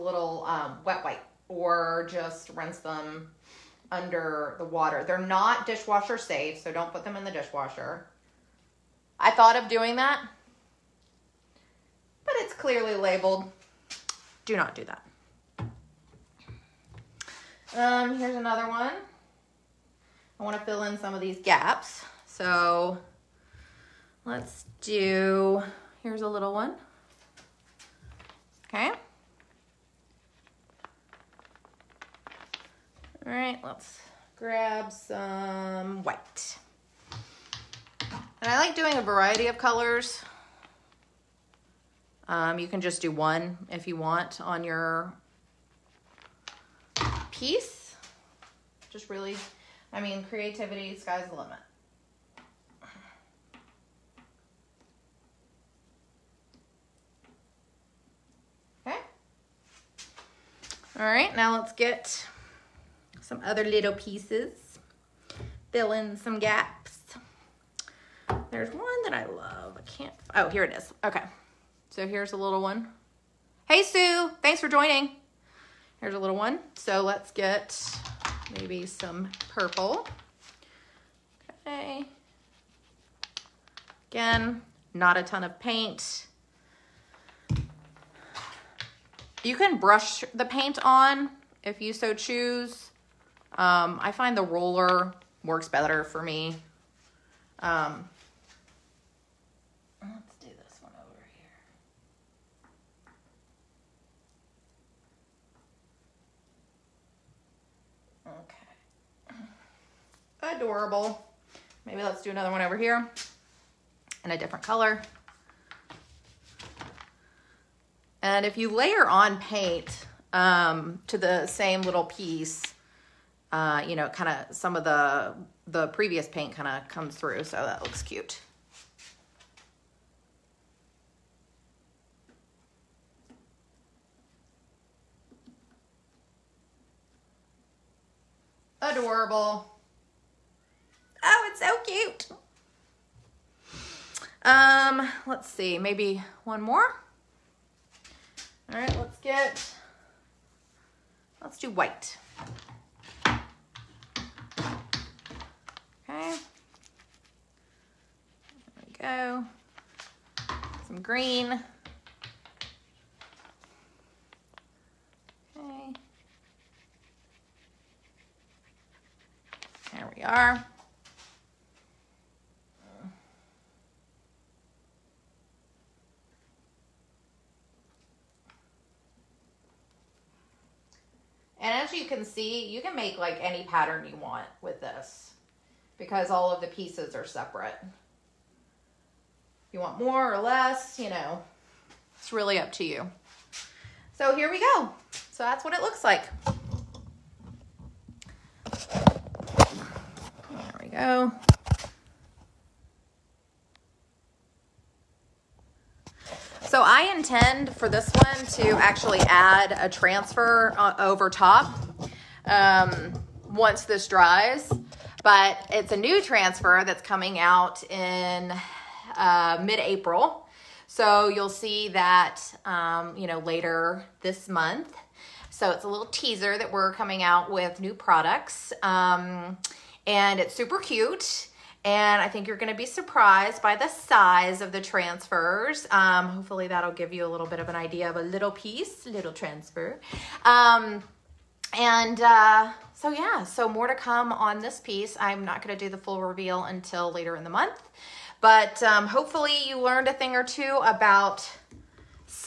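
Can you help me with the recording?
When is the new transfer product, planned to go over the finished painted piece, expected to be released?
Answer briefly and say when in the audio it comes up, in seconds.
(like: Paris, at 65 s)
Mid-April, at 219 s.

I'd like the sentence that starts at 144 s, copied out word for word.
Um, let's see, maybe one more.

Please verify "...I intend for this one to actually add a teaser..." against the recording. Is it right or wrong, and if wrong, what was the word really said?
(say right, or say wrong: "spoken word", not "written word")
wrong: "transfer", not "teaser".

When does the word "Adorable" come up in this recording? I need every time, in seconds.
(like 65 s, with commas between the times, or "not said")
110 s, 138 s.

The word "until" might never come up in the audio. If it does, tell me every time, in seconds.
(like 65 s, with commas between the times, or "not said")
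246 s.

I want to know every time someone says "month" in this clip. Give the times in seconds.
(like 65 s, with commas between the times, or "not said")
224 s, 247 s.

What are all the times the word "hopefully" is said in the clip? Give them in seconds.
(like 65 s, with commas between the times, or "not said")
236 s, 249 s.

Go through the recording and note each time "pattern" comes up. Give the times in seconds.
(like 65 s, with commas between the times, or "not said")
183 s.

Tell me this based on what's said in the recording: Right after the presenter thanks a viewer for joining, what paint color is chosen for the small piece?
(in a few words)
Purple.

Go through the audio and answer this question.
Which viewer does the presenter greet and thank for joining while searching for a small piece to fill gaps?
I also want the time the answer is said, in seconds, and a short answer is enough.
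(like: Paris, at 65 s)
Sue, at 73 s.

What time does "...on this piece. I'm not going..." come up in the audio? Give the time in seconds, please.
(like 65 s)
244 s.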